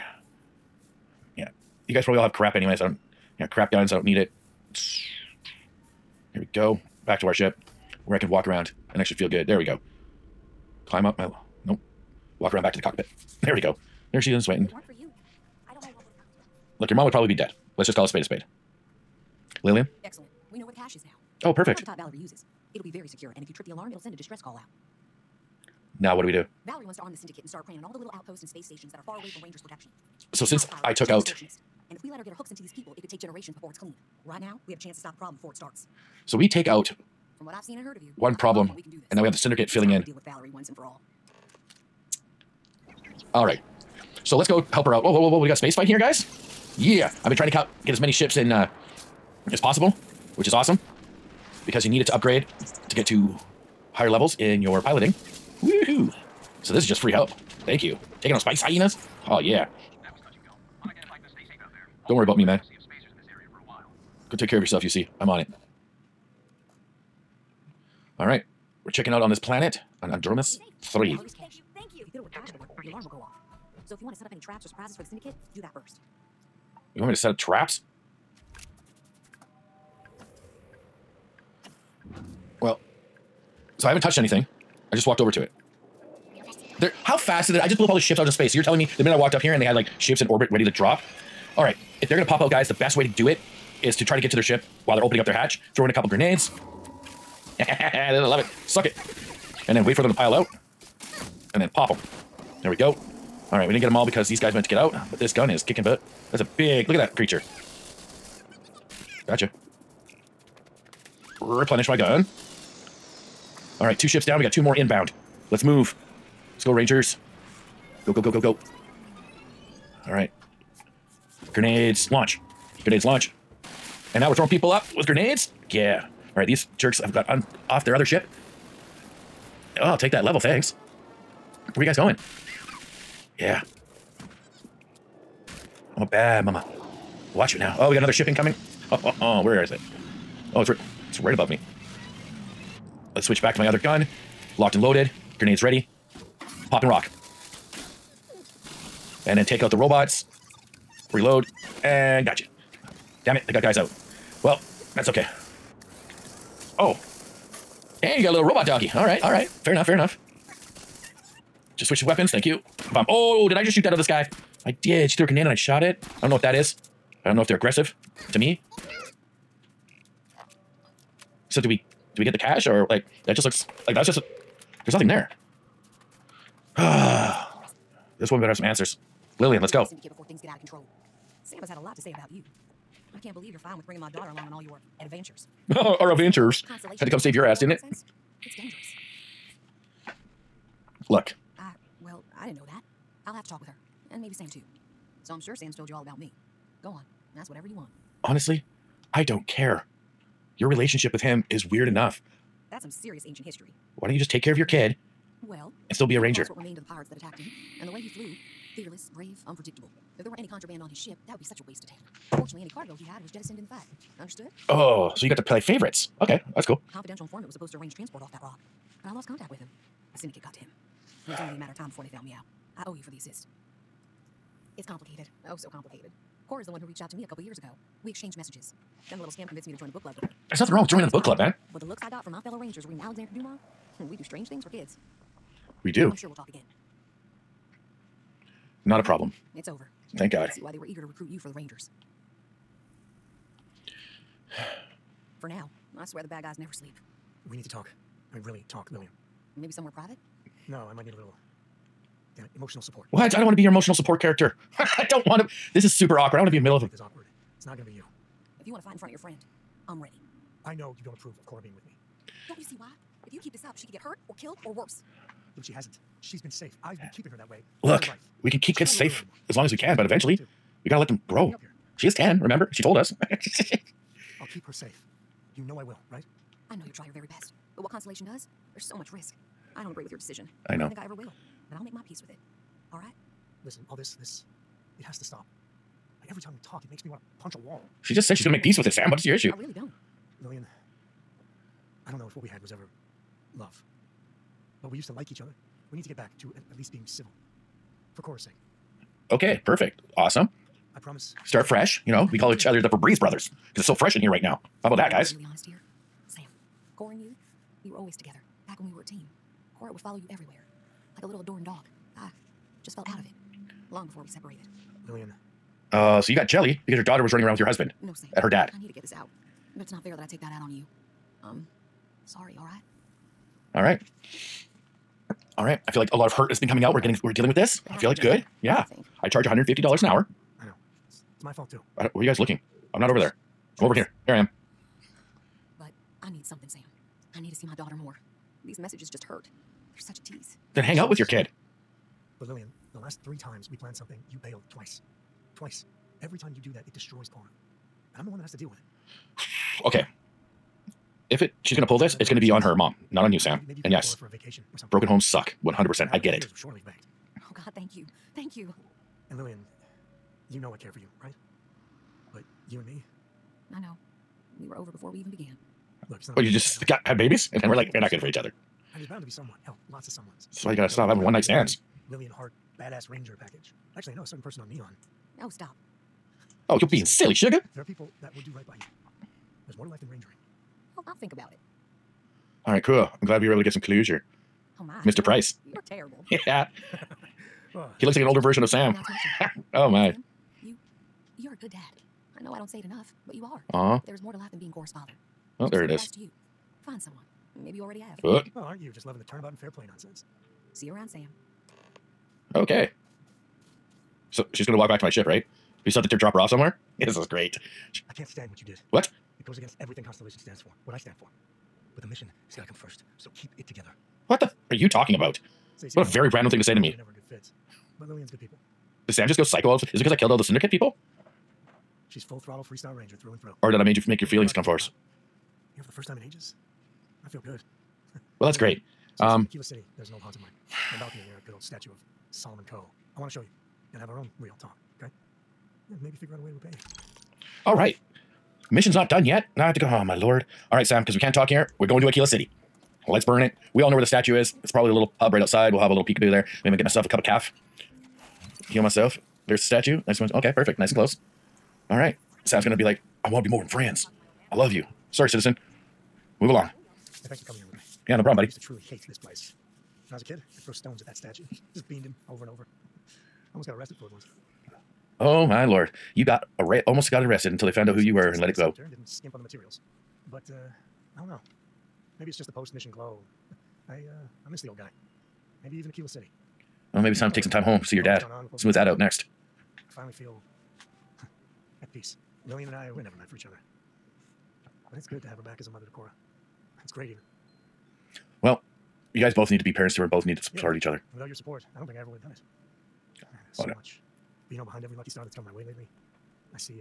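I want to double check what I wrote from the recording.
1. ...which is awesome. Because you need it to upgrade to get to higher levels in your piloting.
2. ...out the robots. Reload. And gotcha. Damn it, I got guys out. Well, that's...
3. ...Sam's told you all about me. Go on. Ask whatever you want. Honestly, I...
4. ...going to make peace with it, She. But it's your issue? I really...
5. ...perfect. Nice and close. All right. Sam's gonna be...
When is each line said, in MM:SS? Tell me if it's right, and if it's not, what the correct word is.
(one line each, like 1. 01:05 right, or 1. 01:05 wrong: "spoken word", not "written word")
1. 00:50 right
2. 02:29 right
3. 03:15 right
4. 04:48 wrong: "Sam", not "She"
5. 07:30 right.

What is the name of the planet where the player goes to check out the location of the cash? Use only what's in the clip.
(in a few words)
Andromas 3.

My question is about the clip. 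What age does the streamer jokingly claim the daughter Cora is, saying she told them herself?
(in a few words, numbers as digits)
10.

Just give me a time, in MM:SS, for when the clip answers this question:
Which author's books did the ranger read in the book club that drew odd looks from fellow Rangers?
03:53.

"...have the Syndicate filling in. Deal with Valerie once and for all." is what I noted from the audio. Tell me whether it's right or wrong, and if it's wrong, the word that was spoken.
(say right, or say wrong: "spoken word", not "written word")
right.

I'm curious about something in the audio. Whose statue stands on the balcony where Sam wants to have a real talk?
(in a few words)
Solomon Coe.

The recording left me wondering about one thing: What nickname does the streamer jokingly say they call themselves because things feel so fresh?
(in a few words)
Febreze brothers.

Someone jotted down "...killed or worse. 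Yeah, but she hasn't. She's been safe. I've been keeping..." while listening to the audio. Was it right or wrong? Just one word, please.
right.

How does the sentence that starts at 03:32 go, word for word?
Fortunately, any cargo he had was jettisoned in the fight.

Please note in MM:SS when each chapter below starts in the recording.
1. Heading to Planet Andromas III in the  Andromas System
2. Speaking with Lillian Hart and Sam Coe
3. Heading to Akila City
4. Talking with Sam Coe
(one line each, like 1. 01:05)
1. 00:42
2. 02:57
3. 07:20
4. 07:35.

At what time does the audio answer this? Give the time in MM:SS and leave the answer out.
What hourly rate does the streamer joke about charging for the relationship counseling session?
05:29.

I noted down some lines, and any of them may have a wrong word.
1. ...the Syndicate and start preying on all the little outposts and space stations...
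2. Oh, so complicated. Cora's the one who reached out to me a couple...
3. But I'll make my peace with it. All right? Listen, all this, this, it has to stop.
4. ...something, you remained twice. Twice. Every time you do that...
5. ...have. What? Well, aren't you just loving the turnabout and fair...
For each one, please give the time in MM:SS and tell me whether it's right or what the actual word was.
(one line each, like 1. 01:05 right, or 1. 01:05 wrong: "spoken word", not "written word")
1. 00:27 right
2. 03:45 right
3. 04:41 right
4. 05:43 wrong: "bailed", not "remained"
5. 06:38 right.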